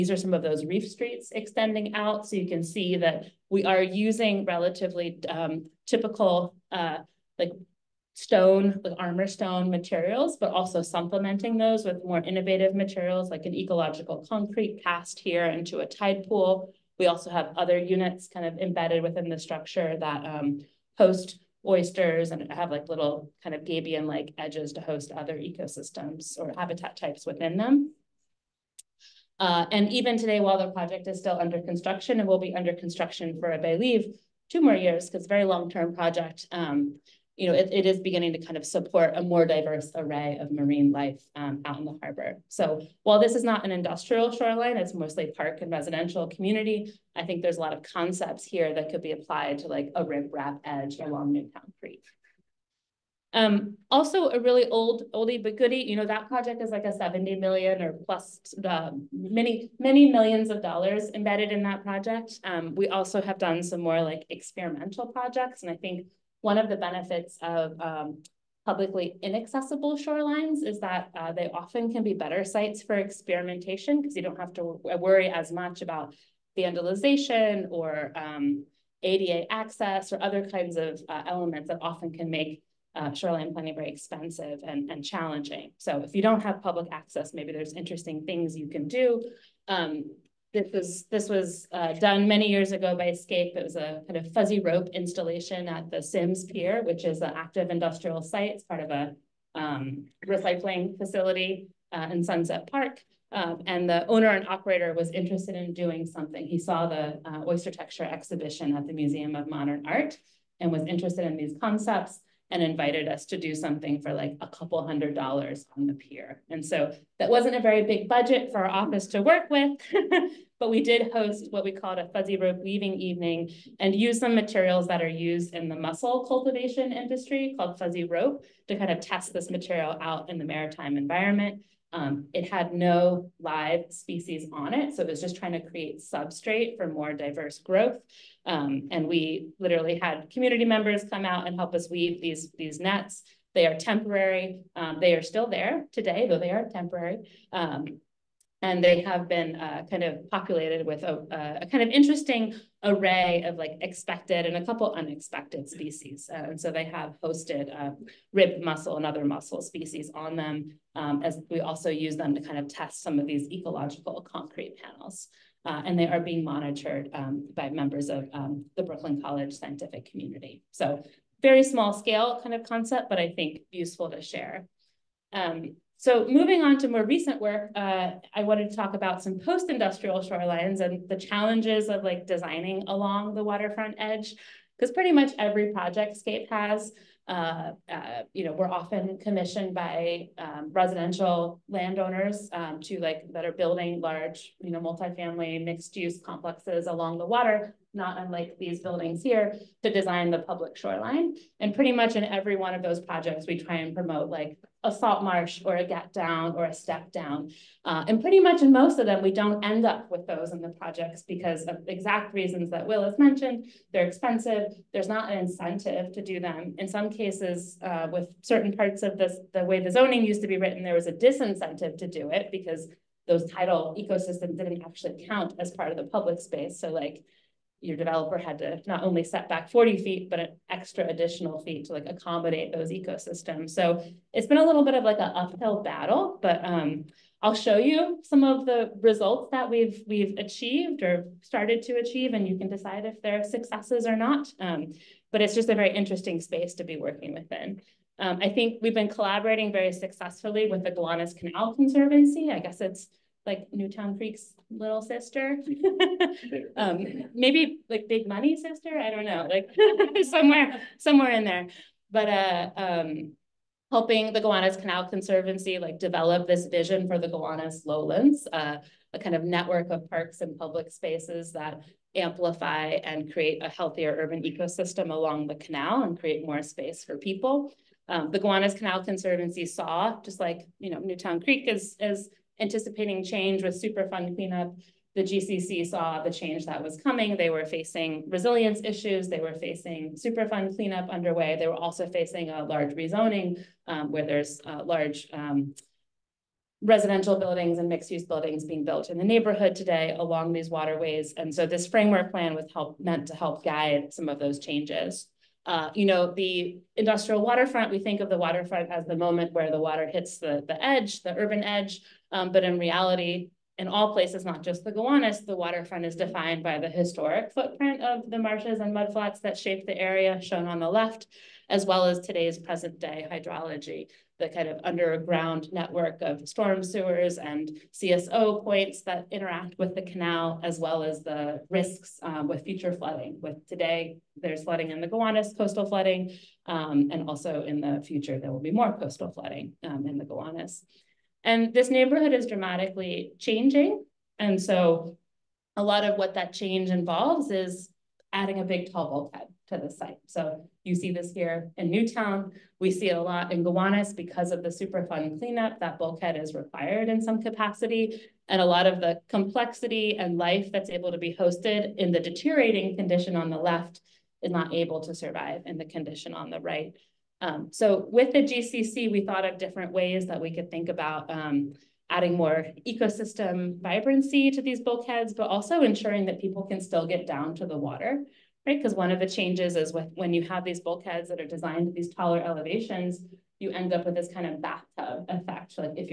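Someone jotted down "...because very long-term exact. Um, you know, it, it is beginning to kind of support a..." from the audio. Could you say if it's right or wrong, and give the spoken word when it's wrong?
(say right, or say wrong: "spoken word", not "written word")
wrong: "project", not "exact".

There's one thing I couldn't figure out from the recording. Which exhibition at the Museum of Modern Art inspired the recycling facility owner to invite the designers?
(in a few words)
Oyster-tecture.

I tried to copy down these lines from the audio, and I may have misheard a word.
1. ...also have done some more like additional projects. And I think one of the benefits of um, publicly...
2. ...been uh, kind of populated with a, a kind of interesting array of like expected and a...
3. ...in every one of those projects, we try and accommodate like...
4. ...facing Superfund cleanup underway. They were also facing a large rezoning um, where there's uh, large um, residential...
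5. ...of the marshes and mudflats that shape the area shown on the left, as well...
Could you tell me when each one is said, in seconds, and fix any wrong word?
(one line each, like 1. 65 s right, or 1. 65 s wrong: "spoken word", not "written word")
1. 62 s wrong: "experimental", not "additional"
2. 149 s right
3. 202 s wrong: "promote", not "accommodate"
4. 289 s right
5. 318 s right.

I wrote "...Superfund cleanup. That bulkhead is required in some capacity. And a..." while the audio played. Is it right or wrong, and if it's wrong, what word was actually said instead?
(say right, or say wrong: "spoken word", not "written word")
right.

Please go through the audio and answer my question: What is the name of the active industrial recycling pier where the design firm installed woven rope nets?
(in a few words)
Sims Pier.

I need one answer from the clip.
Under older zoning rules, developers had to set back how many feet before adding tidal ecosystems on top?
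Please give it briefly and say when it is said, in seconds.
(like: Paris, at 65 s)
40 feet, at 229 s.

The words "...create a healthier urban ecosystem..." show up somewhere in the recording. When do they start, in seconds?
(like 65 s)
273 s.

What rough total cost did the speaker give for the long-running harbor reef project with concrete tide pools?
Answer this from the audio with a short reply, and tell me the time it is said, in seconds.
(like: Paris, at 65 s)
$70 million, at 56 s.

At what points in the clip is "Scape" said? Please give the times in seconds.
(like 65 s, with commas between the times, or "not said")
93 s, 186 s.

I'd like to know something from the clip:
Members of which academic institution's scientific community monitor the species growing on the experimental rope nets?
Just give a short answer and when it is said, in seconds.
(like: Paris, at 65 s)
Brooklyn College, at 168 s.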